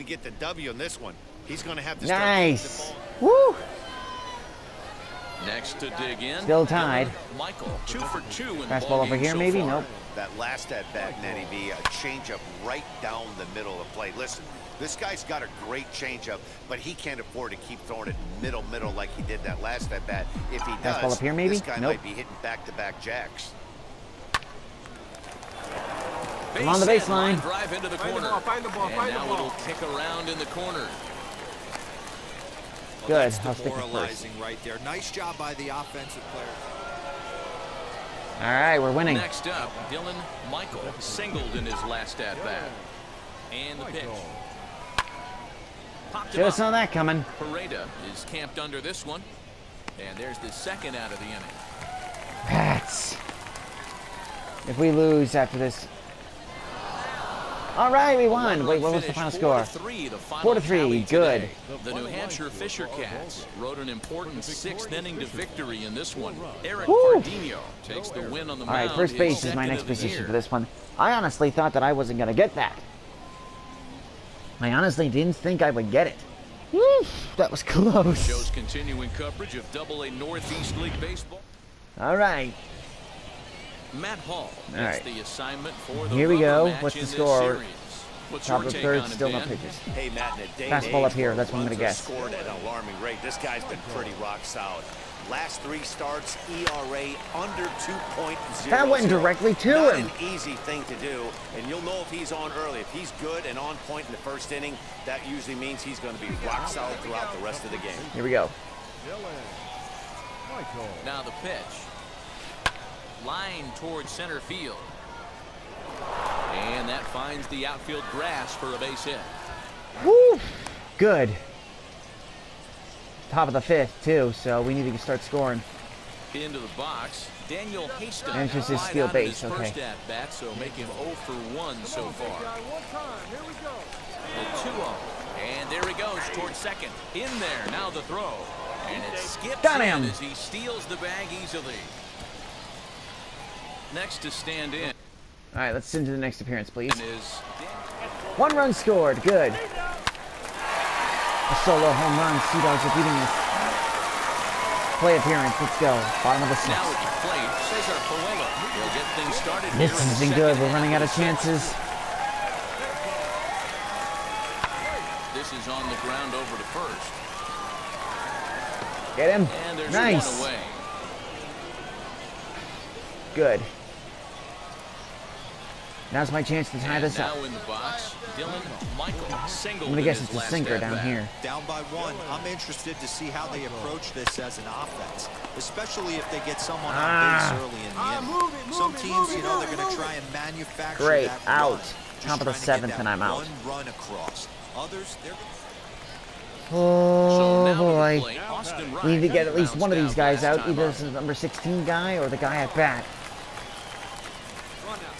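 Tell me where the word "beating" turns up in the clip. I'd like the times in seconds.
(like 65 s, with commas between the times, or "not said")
152 s.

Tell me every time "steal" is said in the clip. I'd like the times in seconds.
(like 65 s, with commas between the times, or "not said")
128 s, 140 s.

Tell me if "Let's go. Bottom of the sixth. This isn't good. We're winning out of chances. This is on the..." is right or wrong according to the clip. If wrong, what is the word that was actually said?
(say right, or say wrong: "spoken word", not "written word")
wrong: "running", not "winning".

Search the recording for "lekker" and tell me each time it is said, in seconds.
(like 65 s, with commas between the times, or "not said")
not said.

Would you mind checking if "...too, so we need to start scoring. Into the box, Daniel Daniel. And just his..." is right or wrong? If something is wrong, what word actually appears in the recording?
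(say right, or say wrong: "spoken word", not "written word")
wrong: "Hastings", not "Daniel".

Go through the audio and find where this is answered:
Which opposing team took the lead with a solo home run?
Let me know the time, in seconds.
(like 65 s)
152 s.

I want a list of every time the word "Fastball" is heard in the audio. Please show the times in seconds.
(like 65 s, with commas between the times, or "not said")
8 s, 20 s, 90 s.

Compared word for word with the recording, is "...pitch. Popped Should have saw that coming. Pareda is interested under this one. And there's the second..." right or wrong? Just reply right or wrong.
wrong.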